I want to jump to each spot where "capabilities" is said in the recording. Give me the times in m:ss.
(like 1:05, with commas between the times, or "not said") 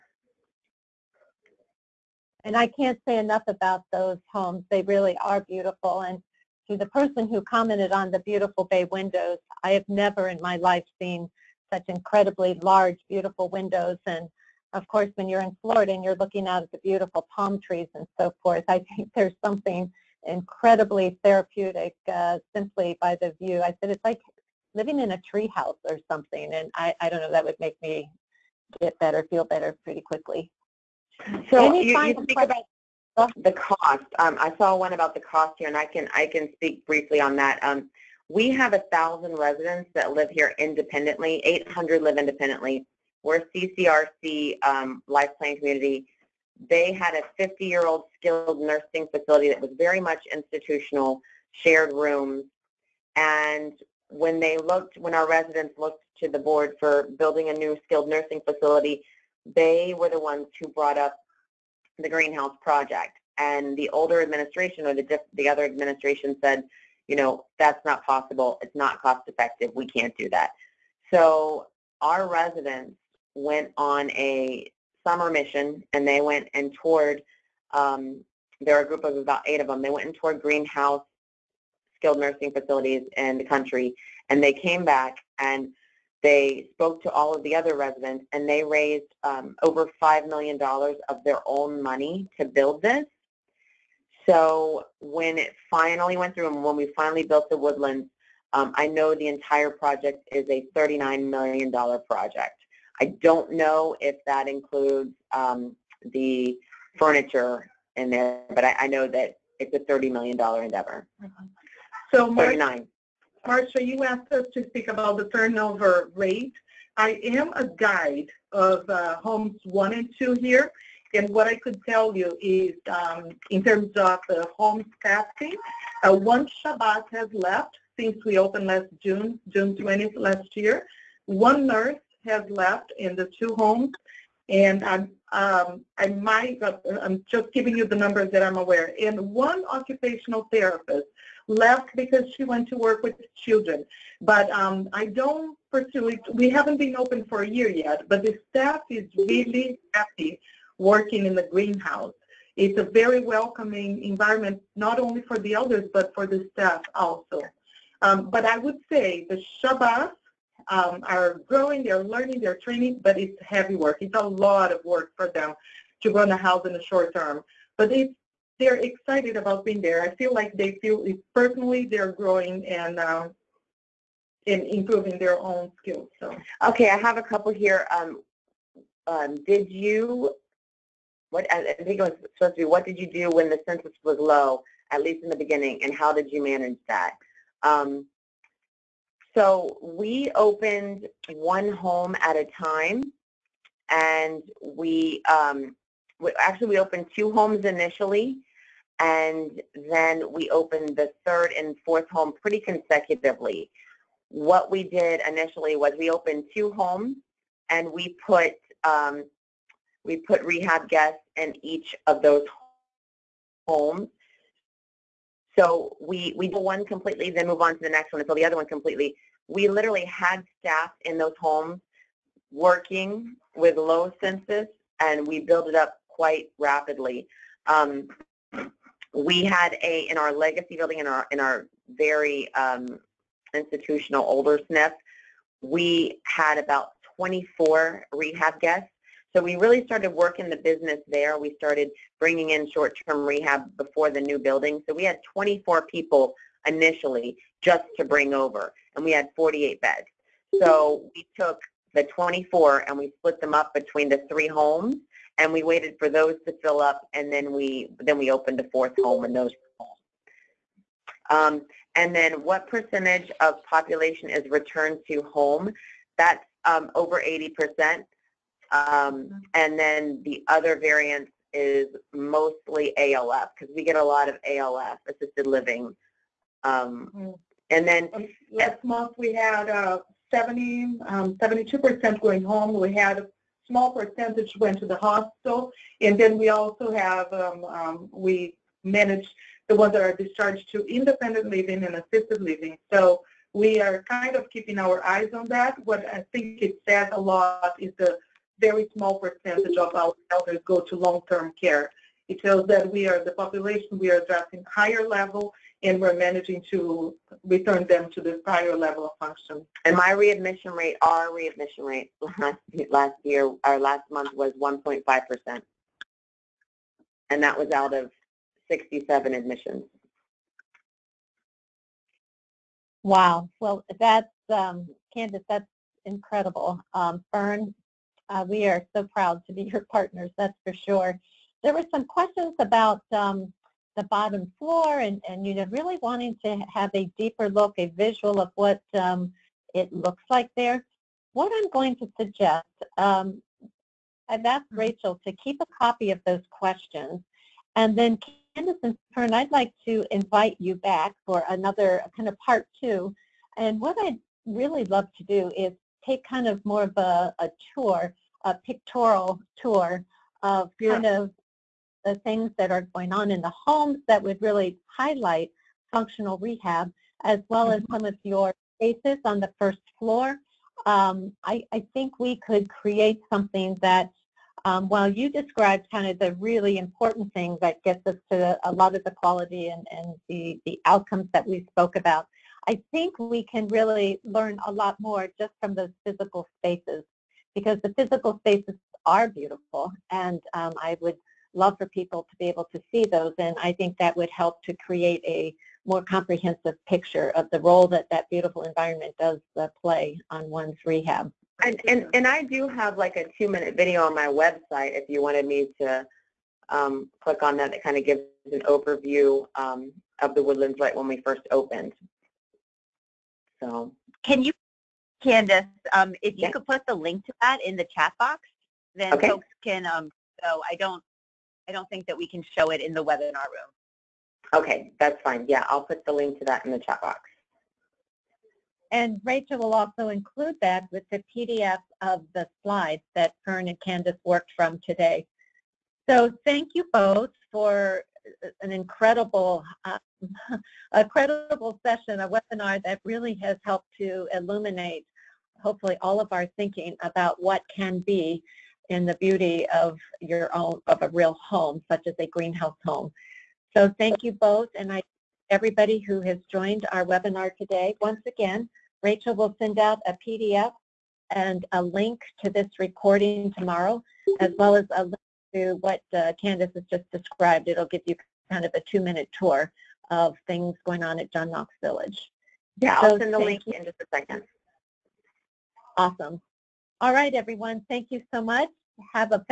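not said.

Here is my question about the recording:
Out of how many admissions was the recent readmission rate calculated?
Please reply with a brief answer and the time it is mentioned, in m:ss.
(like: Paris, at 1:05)
67, at 5:18.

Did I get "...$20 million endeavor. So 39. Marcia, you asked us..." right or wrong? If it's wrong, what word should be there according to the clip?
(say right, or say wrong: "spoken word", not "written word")
wrong: "30", not "20".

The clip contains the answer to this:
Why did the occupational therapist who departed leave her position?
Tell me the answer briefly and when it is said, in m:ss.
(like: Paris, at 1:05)
to work with children, at 2:22.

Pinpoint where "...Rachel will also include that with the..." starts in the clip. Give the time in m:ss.
7:09.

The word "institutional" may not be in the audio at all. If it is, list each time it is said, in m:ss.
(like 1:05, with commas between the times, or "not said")
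0:50, 3:53.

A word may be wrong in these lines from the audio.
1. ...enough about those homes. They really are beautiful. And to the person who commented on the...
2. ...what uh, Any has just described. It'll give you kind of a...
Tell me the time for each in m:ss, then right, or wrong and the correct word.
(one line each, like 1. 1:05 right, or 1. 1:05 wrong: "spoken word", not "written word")
1. 0:03 right
2. 7:45 wrong: "Candace", not "Any".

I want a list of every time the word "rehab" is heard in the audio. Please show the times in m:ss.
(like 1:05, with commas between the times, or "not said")
3:30, 3:58, 4:03, 6:06, 6:40.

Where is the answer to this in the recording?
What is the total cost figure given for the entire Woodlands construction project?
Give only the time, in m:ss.
1:40.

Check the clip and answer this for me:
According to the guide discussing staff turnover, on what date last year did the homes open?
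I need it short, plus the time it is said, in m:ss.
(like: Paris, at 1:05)
June 20th, at 2:09.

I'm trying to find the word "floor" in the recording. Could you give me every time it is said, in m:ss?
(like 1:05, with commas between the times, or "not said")
5:34, 6:09.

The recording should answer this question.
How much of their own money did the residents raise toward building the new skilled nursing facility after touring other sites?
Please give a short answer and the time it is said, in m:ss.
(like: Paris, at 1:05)
over $5 million, at 1:29.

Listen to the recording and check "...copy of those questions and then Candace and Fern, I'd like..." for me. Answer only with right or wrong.
right.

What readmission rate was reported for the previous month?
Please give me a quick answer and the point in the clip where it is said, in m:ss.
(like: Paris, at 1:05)
1.5%, at 5:14.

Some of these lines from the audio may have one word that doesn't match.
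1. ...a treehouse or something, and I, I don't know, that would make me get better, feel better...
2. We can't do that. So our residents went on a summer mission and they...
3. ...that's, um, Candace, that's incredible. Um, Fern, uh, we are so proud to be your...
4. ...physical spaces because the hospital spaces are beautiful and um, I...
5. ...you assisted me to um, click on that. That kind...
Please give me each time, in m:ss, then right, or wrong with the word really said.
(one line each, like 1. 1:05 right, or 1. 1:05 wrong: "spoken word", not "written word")
1. 0:25 right
2. 1:09 right
3. 5:23 right
4. 6:26 wrong: "physical", not "hospital"
5. 6:45 wrong: "wanted", not "assisted".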